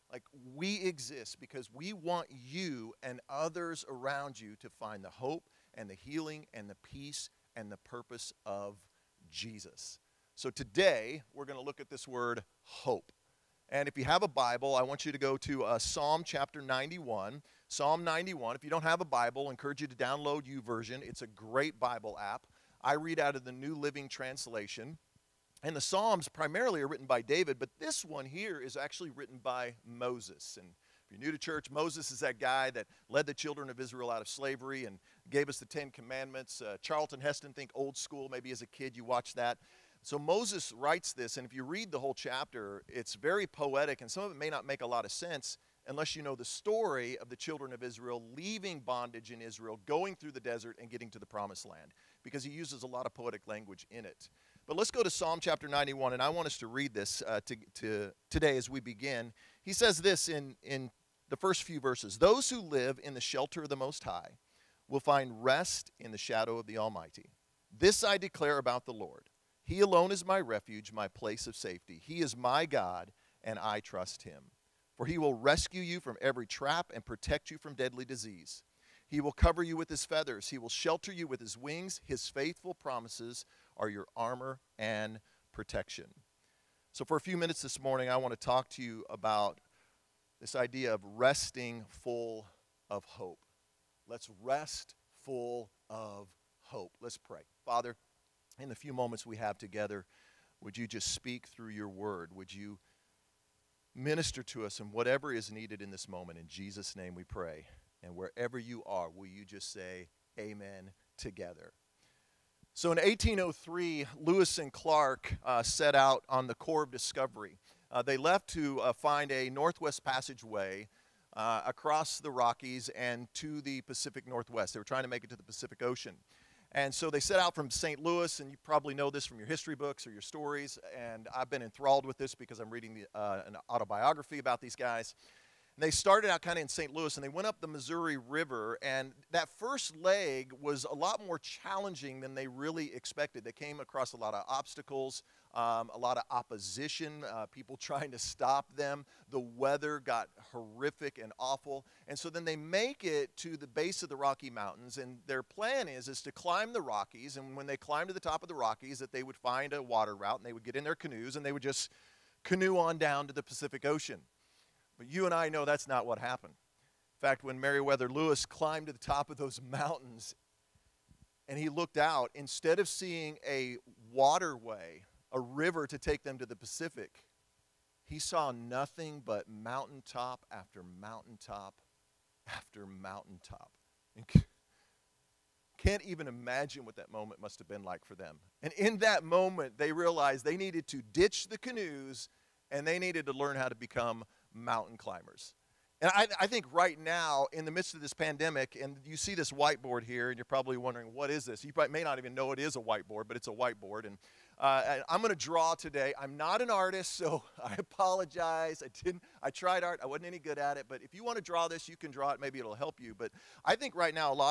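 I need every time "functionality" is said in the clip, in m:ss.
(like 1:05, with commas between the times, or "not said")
not said.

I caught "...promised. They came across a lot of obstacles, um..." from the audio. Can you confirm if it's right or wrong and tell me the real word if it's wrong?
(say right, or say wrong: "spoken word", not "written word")
wrong: "expected", not "promised".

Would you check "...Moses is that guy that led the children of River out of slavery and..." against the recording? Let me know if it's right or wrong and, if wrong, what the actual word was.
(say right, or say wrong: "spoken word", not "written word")
wrong: "Israel", not "River".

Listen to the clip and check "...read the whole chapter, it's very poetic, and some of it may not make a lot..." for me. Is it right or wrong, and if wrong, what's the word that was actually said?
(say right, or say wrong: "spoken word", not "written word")
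right.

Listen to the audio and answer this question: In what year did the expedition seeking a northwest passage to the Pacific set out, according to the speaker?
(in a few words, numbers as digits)
1803.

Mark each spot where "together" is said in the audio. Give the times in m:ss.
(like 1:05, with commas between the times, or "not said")
1:39, 1:51.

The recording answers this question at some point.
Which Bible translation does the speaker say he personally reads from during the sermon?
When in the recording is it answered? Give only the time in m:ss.
0:23.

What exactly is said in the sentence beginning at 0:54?
But let's go to Psalm chapter 91, and I want us to read this uh, to, to today as we begin.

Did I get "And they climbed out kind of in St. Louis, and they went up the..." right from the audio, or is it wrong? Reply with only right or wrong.
wrong.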